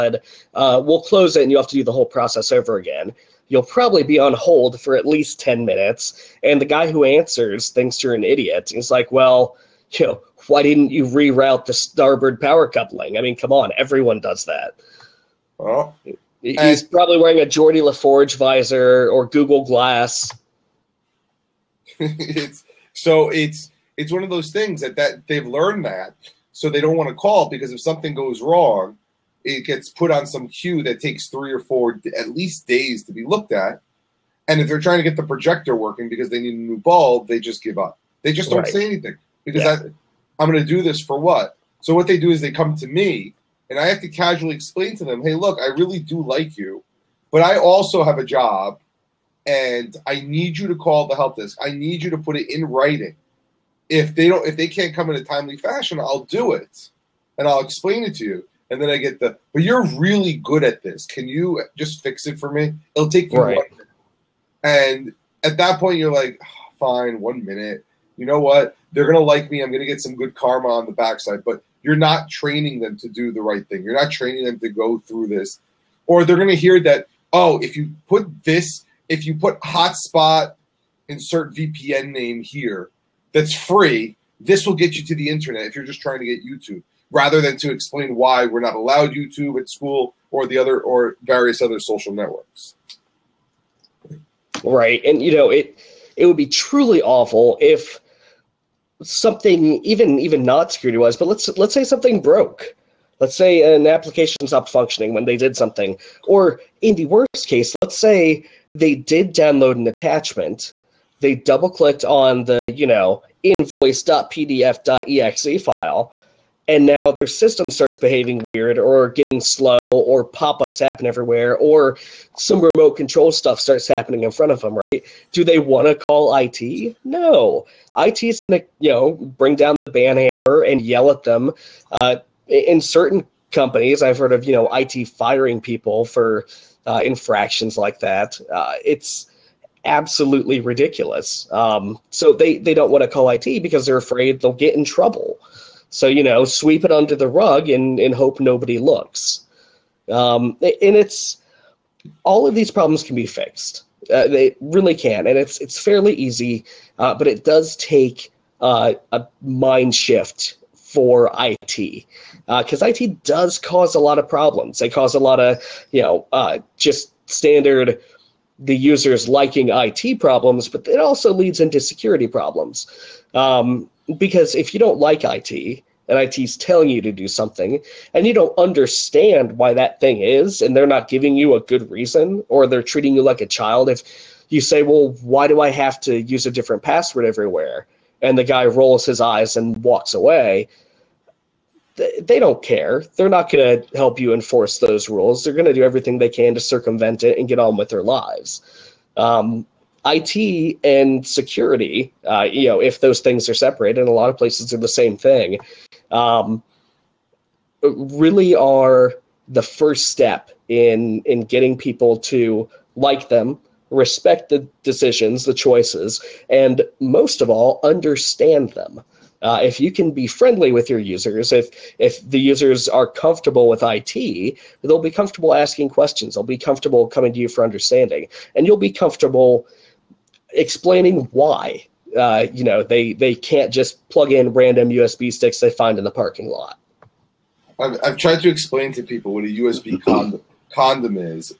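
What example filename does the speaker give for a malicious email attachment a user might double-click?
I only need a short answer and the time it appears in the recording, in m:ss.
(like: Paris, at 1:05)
invoice.pdf.exe, at 1:53.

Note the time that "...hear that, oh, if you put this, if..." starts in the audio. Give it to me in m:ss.
1:16.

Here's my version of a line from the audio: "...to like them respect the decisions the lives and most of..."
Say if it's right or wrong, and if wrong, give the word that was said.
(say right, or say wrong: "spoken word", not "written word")
wrong: "choices", not "lives".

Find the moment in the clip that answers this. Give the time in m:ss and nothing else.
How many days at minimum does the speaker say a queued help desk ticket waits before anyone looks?
0:31.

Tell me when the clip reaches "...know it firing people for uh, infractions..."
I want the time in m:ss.
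2:14.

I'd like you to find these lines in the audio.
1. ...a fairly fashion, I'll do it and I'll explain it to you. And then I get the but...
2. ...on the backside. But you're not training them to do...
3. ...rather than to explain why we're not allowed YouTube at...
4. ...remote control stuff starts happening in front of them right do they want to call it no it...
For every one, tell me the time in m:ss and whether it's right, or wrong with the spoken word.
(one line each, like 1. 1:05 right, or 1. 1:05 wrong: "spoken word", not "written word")
1. 0:55 wrong: "timely", not "fairly"
2. 1:10 right
3. 1:27 right
4. 2:02 right.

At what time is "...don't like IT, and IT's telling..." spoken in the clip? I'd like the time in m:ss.
2:54.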